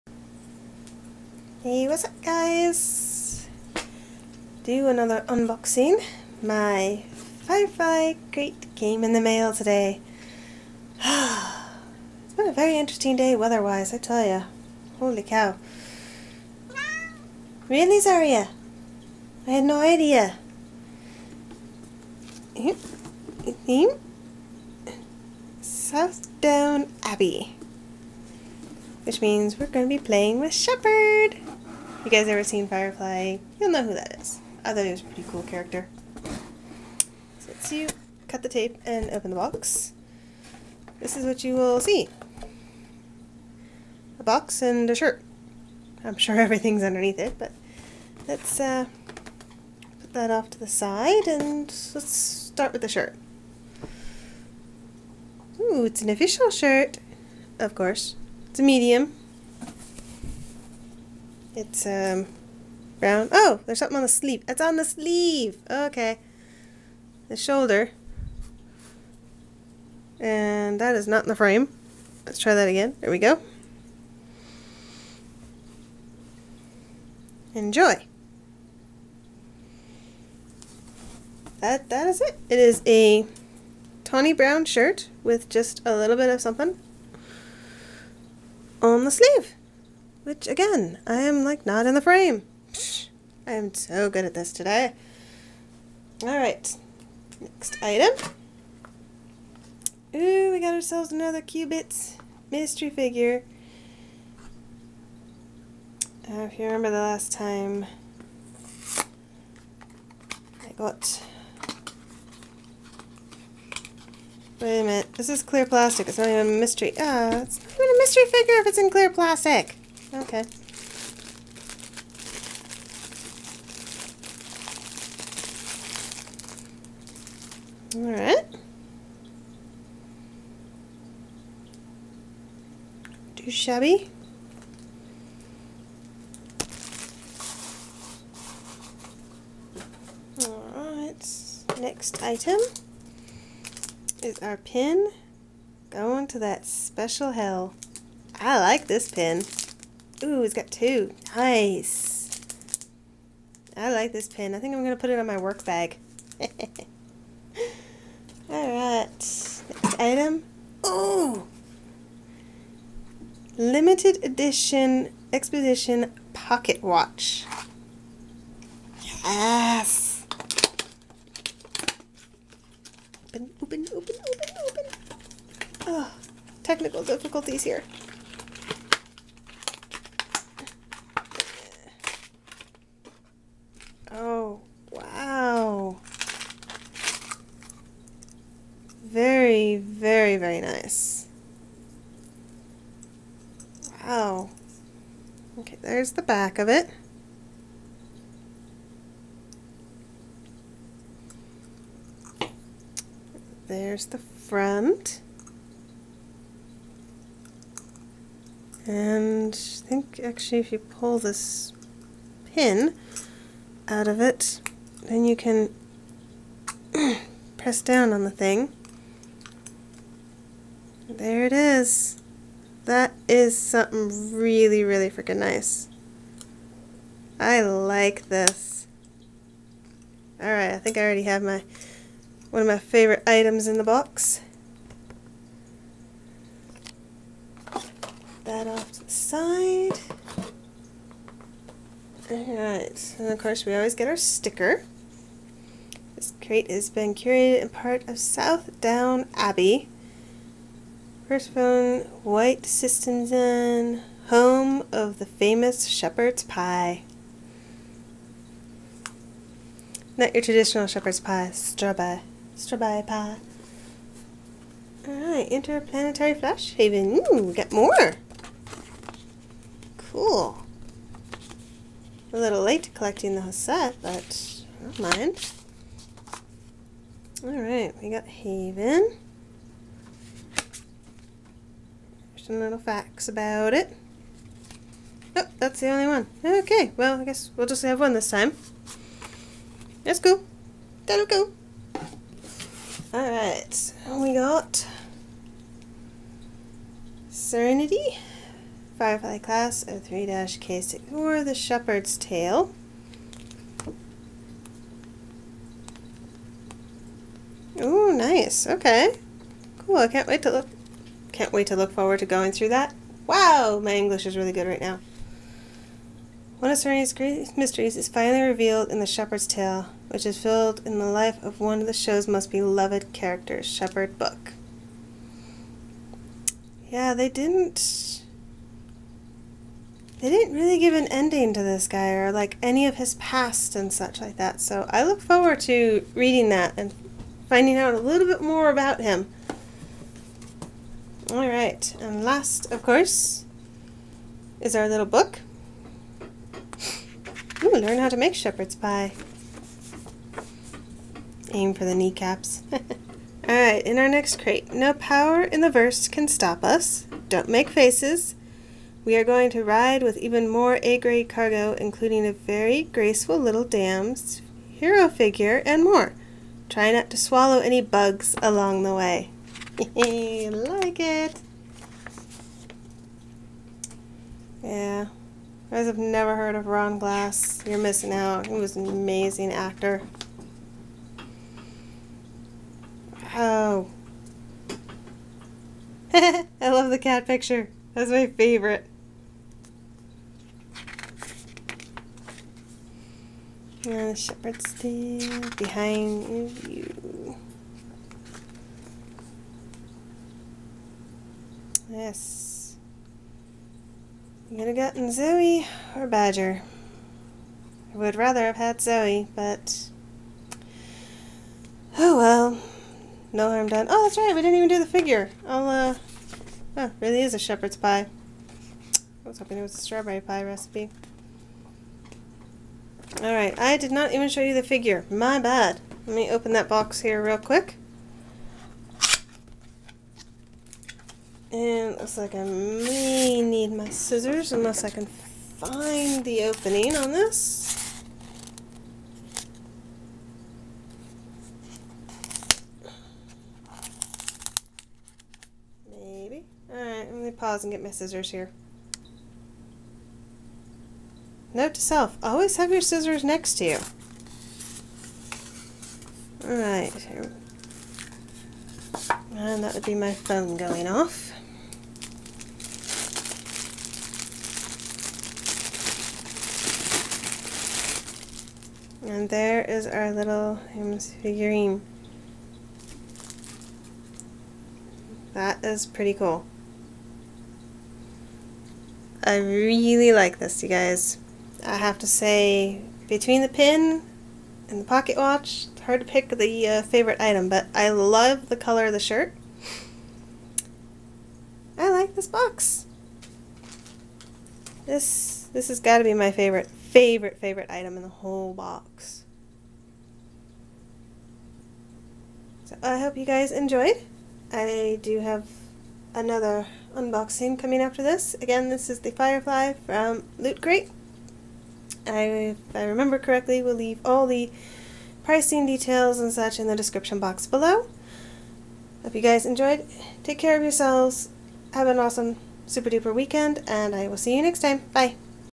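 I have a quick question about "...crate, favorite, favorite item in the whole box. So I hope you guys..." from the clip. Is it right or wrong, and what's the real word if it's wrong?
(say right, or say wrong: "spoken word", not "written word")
wrong: "favorite", not "crate".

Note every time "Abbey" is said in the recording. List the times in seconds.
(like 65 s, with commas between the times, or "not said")
27 s, 249 s.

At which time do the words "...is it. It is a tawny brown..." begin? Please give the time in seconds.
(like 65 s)
82 s.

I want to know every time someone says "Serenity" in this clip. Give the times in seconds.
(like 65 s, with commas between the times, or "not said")
297 s, 316 s.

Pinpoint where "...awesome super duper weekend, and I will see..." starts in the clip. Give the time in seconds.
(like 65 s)
521 s.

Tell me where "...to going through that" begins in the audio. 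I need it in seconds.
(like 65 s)
312 s.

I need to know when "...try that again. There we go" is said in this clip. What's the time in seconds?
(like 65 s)
72 s.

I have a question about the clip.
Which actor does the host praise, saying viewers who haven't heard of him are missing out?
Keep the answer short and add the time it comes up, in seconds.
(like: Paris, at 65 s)
Ron Glass, at 376 s.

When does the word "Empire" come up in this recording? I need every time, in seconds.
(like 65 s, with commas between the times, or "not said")
not said.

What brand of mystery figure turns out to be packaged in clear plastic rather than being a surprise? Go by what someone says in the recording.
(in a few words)
Cubits.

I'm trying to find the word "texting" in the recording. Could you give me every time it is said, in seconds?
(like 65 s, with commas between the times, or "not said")
not said.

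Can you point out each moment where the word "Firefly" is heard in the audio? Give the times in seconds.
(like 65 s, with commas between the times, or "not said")
7 s, 32 s, 298 s, 509 s.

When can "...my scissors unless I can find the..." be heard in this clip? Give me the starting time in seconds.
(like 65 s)
433 s.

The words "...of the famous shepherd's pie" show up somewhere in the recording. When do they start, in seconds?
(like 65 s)
254 s.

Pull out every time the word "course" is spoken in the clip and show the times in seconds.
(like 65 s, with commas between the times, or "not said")
57 s, 243 s, 342 s.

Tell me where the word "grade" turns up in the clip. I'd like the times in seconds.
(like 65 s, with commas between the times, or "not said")
360 s.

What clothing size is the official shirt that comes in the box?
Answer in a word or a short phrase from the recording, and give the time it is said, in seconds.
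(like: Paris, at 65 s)
Medium, at 58 s.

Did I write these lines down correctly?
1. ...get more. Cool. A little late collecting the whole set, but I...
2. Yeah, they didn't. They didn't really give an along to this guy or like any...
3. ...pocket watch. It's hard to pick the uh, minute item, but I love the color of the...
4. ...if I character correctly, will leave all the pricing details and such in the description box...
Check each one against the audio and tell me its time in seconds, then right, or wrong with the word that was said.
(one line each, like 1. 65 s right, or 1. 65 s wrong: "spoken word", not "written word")
1. 267 s right
2. 326 s wrong: "ending", not "along"
3. 484 s wrong: "favorite", not "minute"
4. 512 s wrong: "remember", not "character".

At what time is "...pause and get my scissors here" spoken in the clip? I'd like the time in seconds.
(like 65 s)
447 s.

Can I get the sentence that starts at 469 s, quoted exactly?
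And there is our little Hims figurine.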